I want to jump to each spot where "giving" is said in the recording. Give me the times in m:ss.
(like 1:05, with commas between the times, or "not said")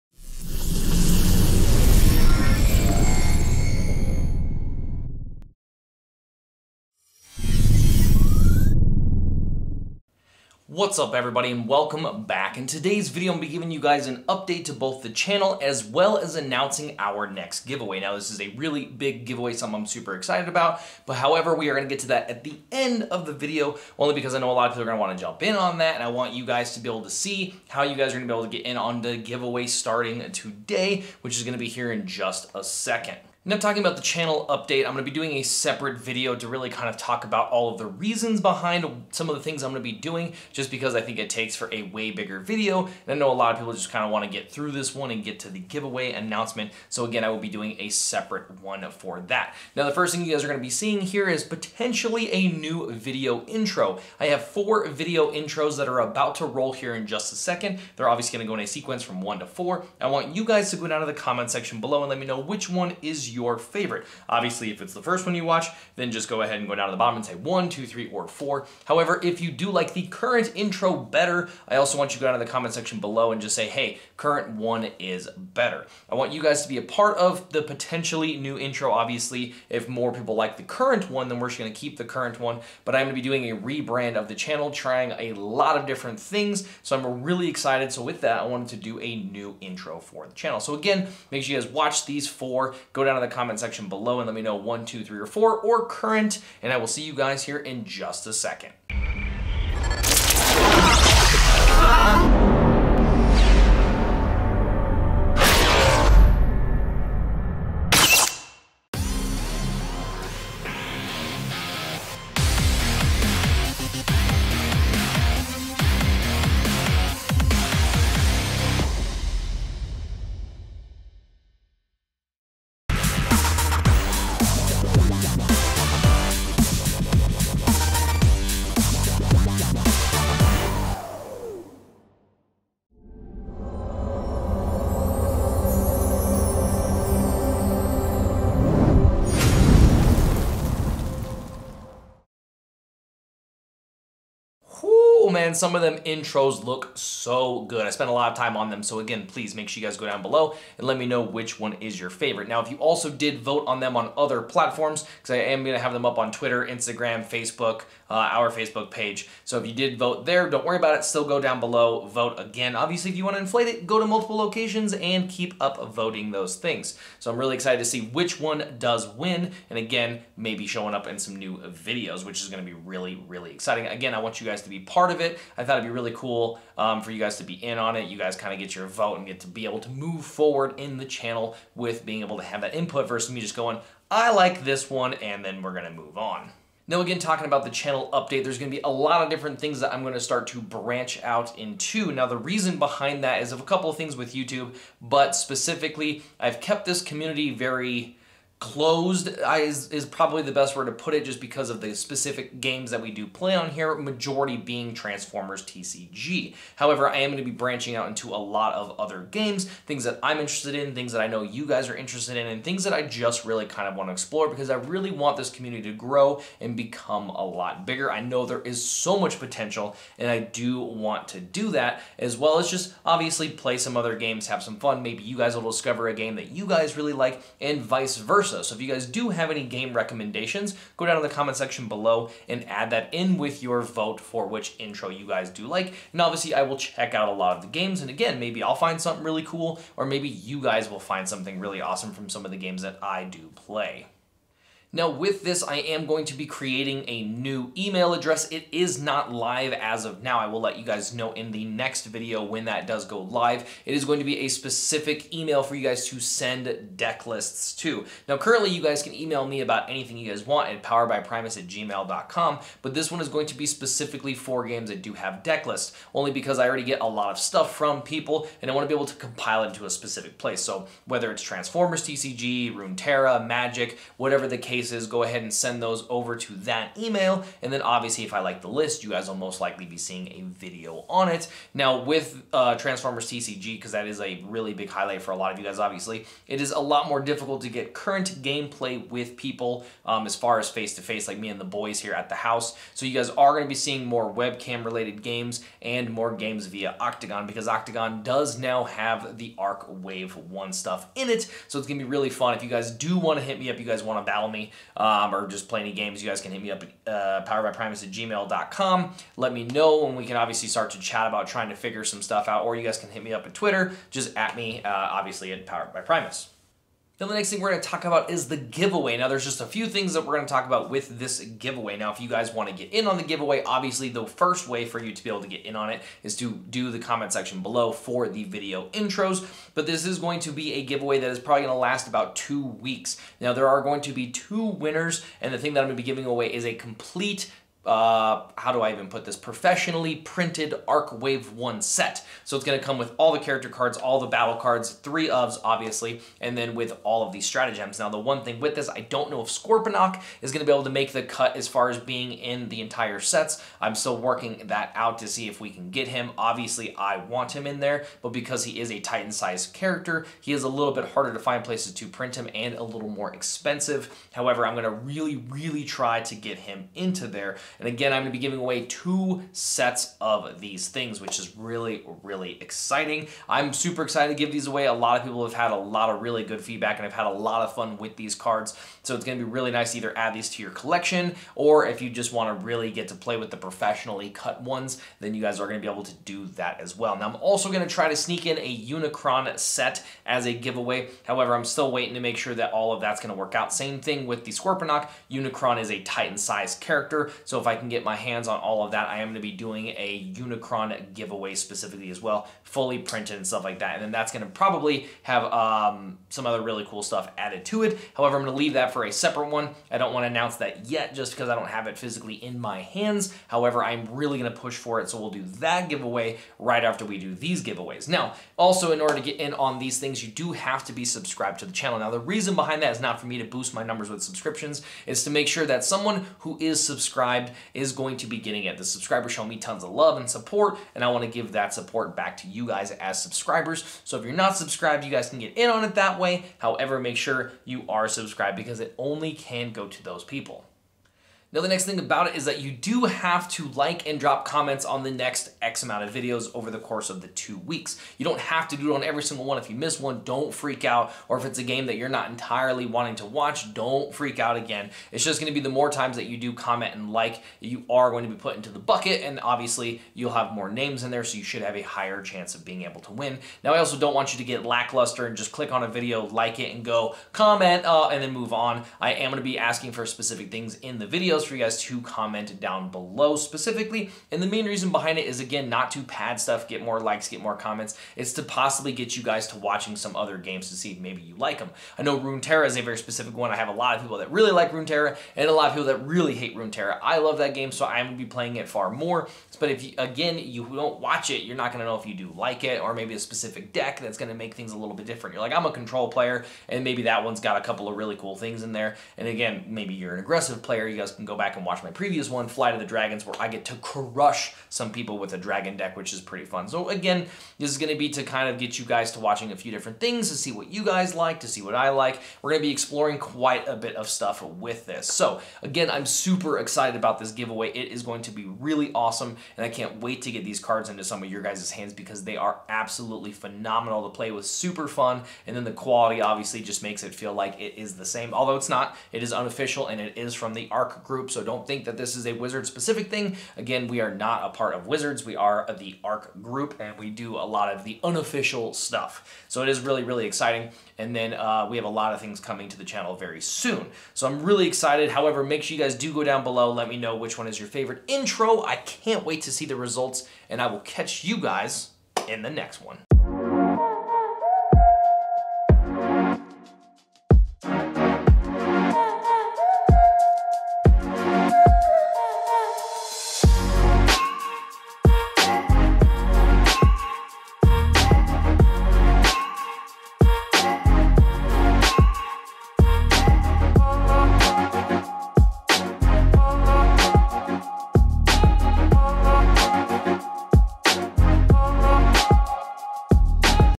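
0:13, 5:36, 6:08.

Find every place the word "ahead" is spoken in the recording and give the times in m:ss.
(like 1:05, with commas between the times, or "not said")
1:06, 4:35.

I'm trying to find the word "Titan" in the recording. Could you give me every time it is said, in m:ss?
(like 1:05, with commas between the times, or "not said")
5:58, 6:36.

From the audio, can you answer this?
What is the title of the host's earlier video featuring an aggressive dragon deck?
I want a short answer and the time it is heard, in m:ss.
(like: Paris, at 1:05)
Fly to the Dragons, at 8:22.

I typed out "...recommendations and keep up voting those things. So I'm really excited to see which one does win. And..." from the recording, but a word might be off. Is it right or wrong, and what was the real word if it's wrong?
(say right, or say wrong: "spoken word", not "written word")
wrong: "locations", not "recommendations".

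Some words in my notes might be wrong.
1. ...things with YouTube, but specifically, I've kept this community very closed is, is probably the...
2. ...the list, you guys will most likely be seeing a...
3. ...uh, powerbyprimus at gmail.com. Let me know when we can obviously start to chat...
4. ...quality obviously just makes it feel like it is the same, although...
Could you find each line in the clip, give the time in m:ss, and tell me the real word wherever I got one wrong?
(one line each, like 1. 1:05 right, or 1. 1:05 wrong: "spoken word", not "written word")
1. 3:13 right
2. 4:38 right
3. 5:07 right
4. 8:45 right.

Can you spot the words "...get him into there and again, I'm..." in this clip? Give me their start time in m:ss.
6:06.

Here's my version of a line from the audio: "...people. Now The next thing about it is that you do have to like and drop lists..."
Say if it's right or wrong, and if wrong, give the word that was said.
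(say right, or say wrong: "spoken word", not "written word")
wrong: "comments", not "lists".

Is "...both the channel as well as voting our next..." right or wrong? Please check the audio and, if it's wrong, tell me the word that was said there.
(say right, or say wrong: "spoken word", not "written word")
wrong: "announcing", not "voting".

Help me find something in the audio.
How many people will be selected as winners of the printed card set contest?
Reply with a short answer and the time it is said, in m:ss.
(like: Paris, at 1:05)
2, at 5:34.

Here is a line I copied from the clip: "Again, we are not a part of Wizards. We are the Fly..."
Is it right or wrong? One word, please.
wrong.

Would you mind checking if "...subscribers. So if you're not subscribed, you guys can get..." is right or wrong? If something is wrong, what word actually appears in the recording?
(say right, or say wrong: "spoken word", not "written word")
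right.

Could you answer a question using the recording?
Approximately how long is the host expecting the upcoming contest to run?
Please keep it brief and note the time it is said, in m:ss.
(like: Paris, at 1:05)
2 weeks, at 5:32.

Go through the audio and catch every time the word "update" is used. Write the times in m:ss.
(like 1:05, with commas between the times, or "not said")
0:14, 0:34, 3:08.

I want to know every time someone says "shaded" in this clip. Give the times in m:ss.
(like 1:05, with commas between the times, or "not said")
not said.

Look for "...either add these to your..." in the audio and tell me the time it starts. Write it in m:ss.
6:19.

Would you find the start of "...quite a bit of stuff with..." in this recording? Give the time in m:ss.
8:33.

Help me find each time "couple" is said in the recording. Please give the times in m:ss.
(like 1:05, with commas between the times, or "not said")
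3:13, 8:17.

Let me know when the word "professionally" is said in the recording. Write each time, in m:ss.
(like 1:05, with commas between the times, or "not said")
5:39, 6:23.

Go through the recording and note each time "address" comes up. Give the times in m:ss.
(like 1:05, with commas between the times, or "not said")
4:08.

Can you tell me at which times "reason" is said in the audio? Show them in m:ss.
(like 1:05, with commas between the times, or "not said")
0:37, 3:12, 7:02, 7:54.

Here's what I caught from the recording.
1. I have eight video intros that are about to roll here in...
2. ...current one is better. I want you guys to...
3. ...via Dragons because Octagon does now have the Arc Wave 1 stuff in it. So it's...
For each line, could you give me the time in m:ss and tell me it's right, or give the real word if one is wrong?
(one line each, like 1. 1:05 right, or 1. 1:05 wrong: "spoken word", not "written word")
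1. 0:54 wrong: "four", not "eight"
2. 1:14 right
3. 4:56 wrong: "Octagon", not "Dragons".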